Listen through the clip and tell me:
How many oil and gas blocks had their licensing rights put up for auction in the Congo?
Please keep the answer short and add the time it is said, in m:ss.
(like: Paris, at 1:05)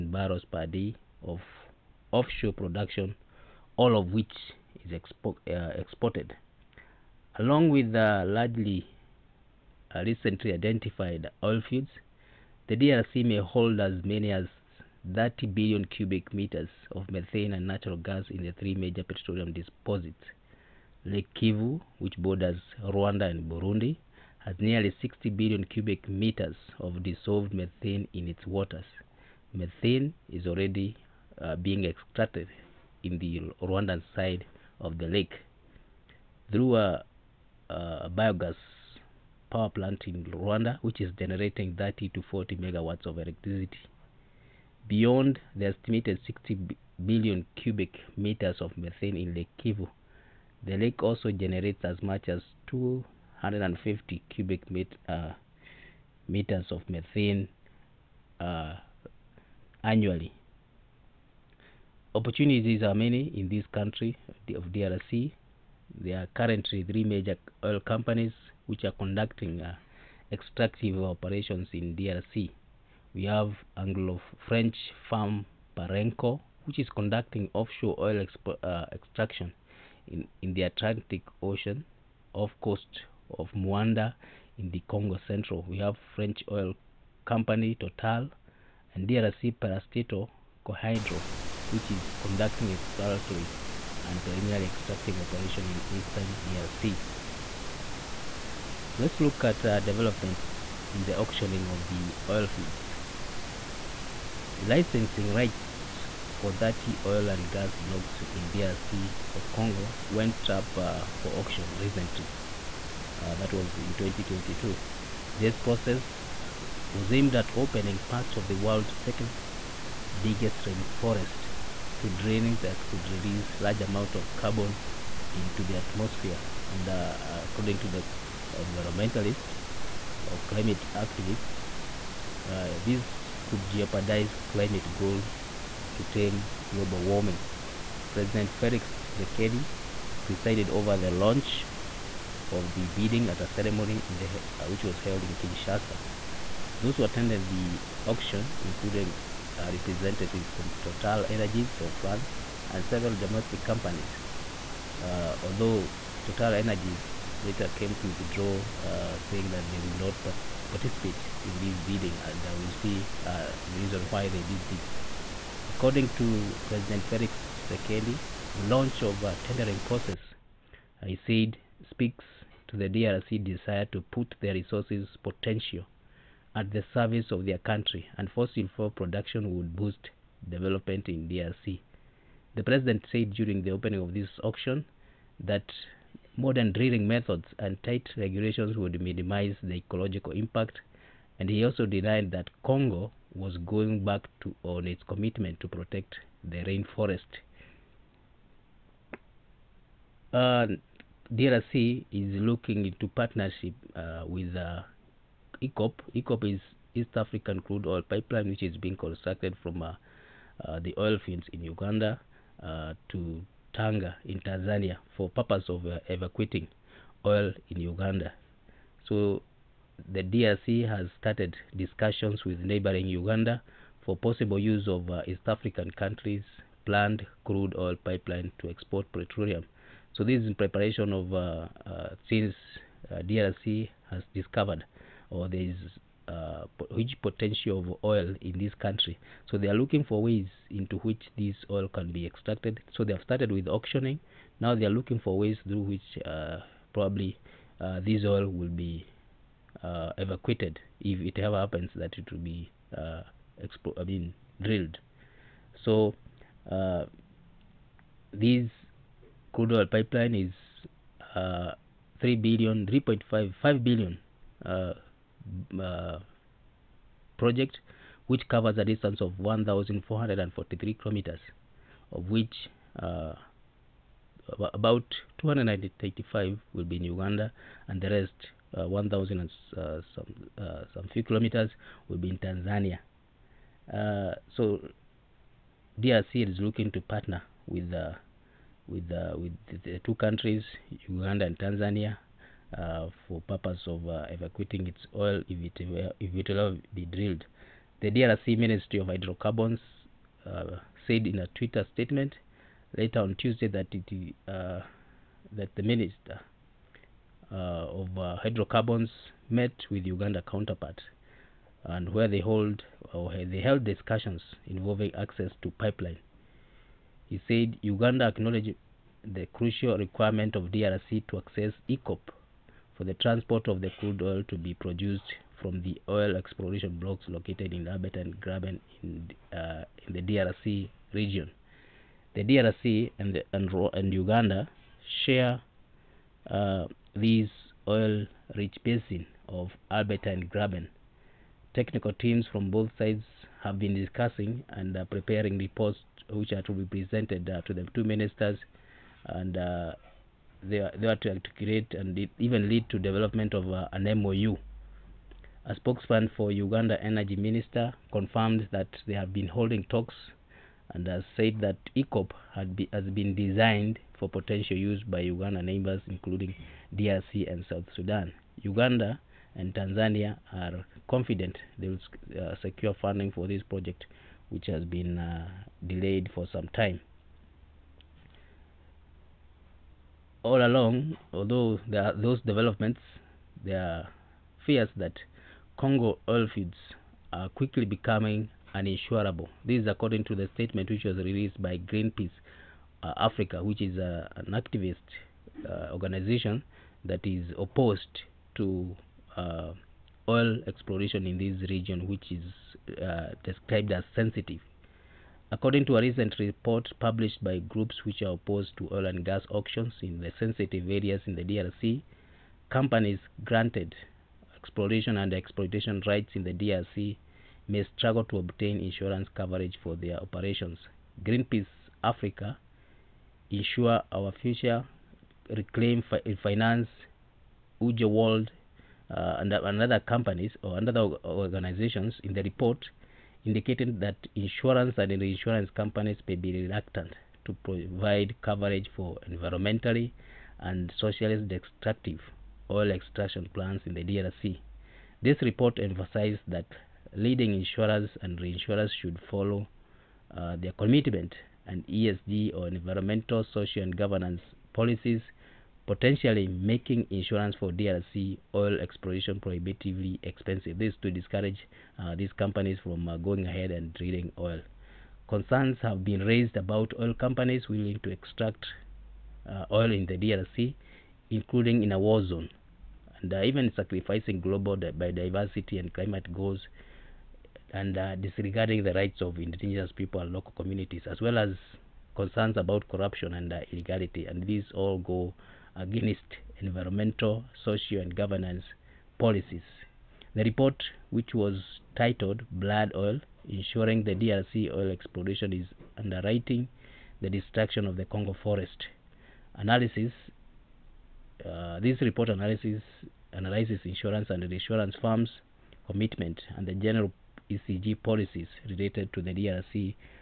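30, at 1:46.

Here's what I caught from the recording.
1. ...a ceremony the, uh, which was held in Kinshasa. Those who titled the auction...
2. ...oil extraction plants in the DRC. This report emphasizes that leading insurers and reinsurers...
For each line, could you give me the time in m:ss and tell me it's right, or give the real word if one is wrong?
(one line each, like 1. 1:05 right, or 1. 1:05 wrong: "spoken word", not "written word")
1. 2:23 wrong: "attended", not "titled"
2. 7:22 right.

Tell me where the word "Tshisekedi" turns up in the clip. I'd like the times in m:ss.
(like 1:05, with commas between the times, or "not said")
2:19, 2:47.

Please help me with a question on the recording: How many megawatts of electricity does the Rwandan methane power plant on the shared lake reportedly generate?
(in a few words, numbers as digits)
30 to 40.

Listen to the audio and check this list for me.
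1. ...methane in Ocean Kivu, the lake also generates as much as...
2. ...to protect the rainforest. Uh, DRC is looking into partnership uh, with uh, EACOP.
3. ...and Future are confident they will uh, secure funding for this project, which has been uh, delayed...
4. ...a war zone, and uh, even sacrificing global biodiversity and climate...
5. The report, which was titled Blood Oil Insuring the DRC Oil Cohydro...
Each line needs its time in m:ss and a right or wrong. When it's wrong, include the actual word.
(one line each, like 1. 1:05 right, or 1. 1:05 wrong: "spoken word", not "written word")
1. 0:48 wrong: "Lake", not "Ocean"
2. 3:15 right
3. 6:09 wrong: "Tanzania", not "Future"
4. 7:51 right
5. 8:10 wrong: "Exploration", not "Cohydro".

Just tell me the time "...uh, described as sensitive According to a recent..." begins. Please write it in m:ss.
6:43.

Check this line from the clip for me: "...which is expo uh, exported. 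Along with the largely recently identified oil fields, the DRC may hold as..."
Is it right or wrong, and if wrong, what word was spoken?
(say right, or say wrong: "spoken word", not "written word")
right.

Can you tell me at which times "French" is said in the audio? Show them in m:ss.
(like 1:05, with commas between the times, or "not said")
1:13, 1:26.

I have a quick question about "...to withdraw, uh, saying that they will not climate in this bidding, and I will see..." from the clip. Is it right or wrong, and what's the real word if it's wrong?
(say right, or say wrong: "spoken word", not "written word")
wrong: "participate", not "climate".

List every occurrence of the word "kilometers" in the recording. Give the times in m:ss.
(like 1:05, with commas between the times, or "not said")
4:30, 4:41.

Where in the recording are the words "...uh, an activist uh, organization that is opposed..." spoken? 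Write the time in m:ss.
6:33.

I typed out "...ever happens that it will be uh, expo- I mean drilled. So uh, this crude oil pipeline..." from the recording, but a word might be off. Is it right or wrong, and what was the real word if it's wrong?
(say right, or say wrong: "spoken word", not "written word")
right.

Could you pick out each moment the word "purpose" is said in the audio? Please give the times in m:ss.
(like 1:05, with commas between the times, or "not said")
3:35, 4:53.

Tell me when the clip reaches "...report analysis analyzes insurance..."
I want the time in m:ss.
8:22.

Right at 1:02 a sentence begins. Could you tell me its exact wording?
Opportunities are many in this country of DRC.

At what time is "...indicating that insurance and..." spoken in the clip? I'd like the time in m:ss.
7:13.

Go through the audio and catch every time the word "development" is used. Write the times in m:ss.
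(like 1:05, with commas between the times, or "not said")
1:39, 3:00, 5:52, 6:22.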